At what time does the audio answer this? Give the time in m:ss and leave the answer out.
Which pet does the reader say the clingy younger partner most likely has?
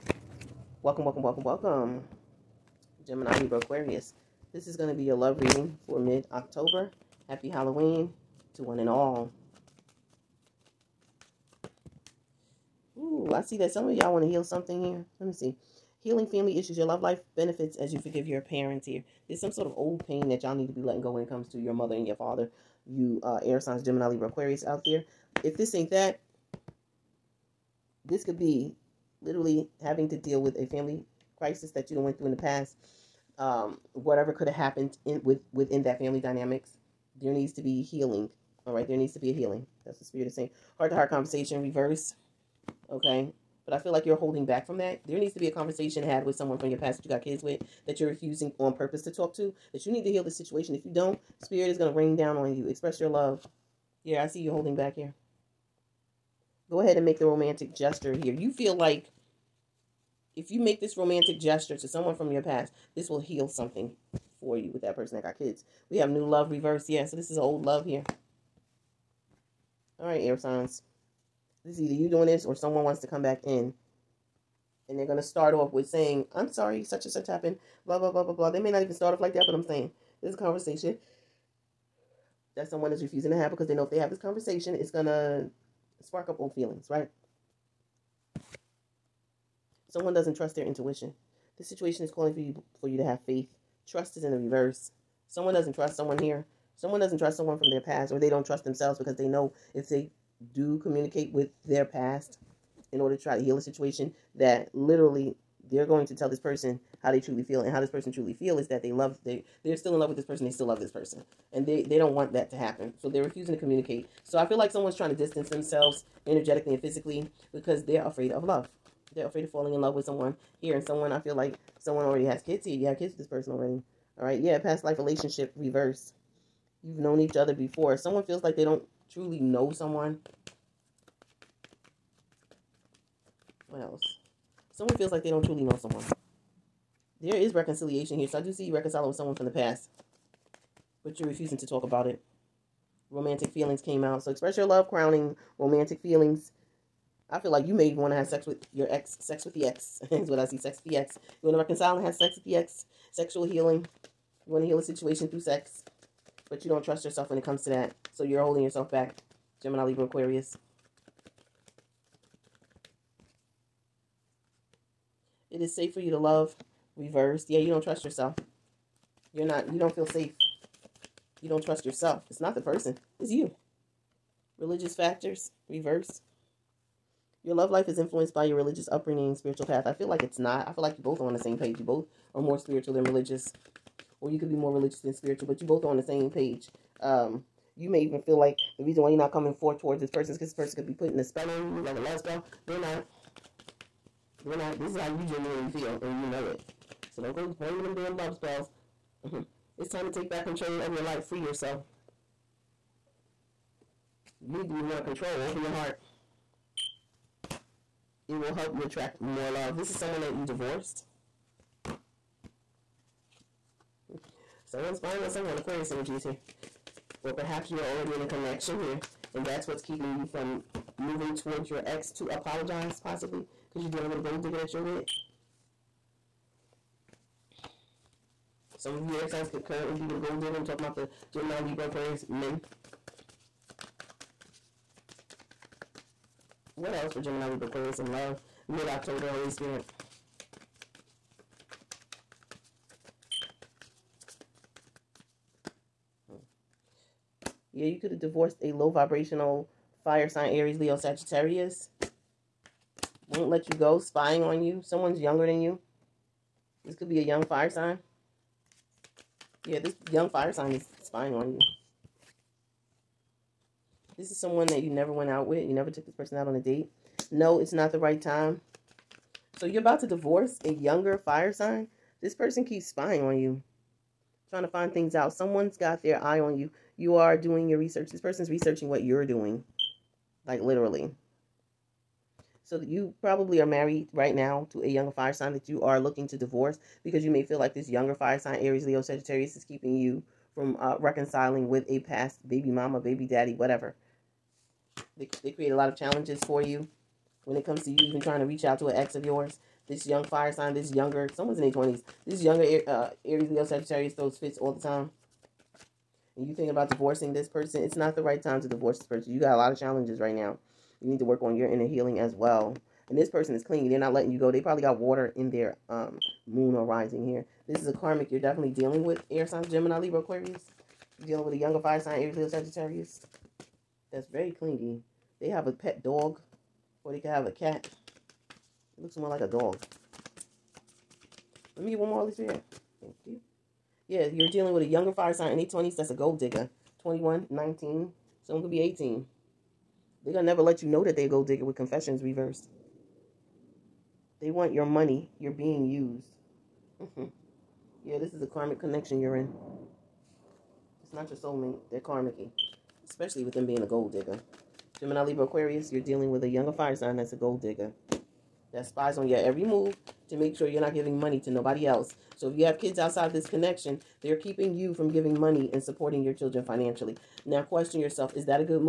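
5:28.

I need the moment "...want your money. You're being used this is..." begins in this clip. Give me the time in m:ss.
5:44.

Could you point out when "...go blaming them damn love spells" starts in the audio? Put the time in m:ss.
3:17.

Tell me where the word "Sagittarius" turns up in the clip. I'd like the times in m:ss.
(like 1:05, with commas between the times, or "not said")
4:10, 4:49, 5:03, 5:22.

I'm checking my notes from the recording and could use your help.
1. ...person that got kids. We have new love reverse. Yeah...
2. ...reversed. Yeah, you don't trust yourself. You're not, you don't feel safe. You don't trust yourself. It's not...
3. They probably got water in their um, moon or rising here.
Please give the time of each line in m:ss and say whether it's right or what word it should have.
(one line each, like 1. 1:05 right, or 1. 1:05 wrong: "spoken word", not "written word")
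1. 1:04 right
2. 2:46 right
3. 5:14 right.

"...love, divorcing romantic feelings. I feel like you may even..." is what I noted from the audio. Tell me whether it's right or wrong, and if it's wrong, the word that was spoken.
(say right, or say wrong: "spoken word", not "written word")
wrong: "crowning", not "divorcing".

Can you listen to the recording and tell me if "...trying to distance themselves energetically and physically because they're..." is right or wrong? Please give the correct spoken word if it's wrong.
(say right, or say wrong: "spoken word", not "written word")
right.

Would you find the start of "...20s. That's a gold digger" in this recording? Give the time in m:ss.
5:35.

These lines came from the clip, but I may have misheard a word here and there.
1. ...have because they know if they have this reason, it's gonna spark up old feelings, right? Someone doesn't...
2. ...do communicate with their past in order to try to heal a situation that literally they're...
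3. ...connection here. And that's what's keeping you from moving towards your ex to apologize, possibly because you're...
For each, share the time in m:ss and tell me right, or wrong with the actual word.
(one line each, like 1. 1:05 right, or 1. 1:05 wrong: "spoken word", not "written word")
1. 1:23 wrong: "conversation", not "reason"
2. 1:40 right
3. 3:38 right.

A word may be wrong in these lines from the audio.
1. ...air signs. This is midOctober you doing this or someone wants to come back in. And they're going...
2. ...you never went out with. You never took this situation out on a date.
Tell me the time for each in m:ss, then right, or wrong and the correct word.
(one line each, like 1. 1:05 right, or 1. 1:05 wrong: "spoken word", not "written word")
1. 1:10 wrong: "either", not "midOctober"
2. 4:24 wrong: "person", not "situation".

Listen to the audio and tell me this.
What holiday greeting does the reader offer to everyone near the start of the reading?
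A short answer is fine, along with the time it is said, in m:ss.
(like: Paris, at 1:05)
Happy Halloween, at 0:07.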